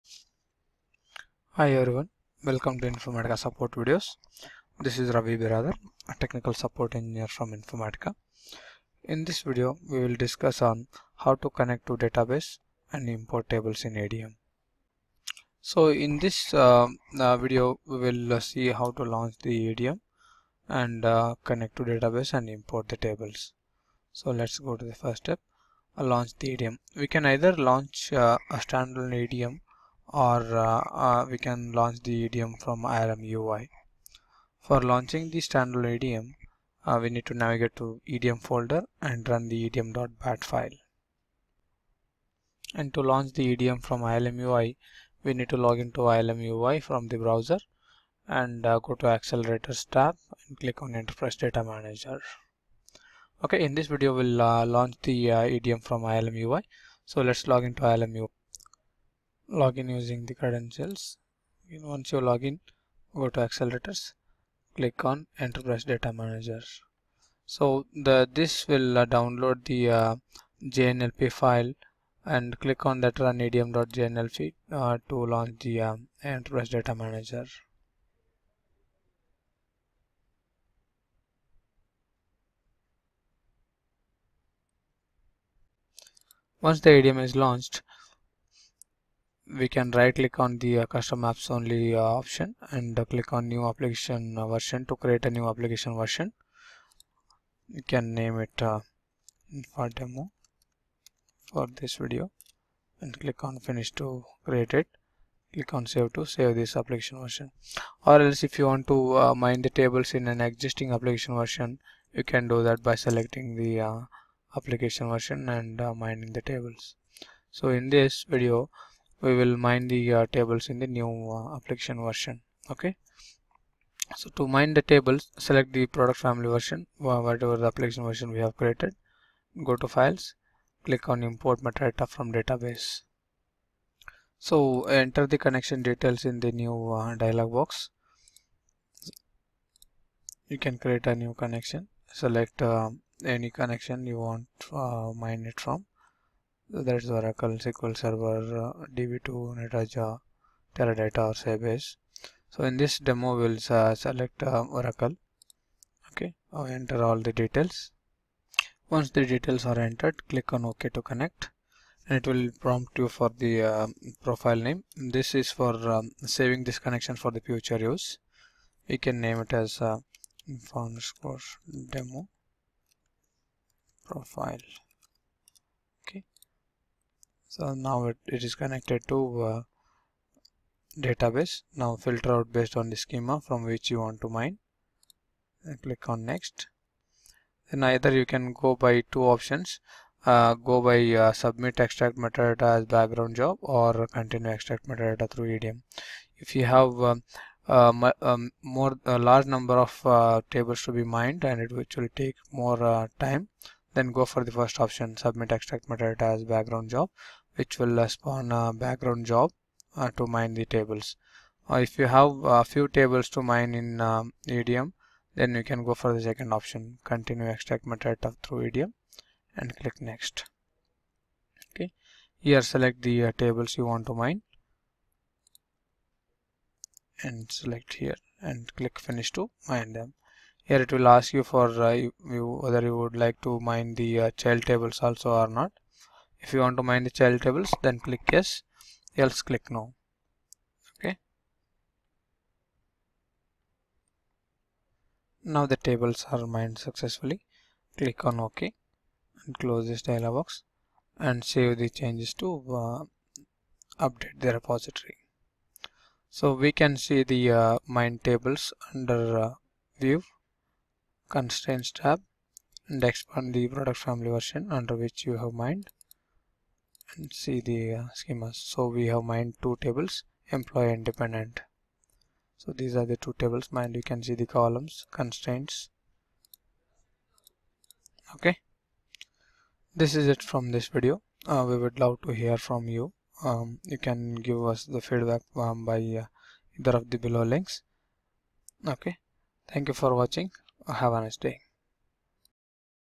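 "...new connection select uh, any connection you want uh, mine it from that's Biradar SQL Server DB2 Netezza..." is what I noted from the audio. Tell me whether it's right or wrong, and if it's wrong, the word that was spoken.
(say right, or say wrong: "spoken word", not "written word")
wrong: "Oracle", not "Biradar".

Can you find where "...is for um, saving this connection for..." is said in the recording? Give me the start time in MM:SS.
02:45.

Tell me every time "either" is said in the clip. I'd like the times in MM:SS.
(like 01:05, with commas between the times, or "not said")
00:27, 03:07, 04:46.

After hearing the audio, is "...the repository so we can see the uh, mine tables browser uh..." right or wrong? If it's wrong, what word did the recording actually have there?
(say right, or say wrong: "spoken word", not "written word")
wrong: "under", not "browser".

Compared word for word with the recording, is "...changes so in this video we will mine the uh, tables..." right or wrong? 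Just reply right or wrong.
wrong.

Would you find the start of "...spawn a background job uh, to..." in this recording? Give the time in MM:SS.
03:28.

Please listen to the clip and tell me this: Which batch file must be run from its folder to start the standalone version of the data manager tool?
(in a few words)
EDM.bat.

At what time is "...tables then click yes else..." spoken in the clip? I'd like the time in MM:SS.
03:57.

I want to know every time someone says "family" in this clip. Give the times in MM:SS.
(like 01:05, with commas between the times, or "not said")
02:06, 04:24.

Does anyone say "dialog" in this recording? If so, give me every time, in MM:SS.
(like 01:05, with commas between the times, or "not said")
02:17, 04:10.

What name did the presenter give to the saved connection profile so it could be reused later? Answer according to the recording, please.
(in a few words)
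Demo Profile.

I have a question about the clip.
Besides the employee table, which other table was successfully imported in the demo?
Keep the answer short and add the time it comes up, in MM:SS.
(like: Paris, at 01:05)
dependent, at 04:31.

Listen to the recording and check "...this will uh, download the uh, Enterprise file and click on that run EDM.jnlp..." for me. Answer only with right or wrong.
wrong.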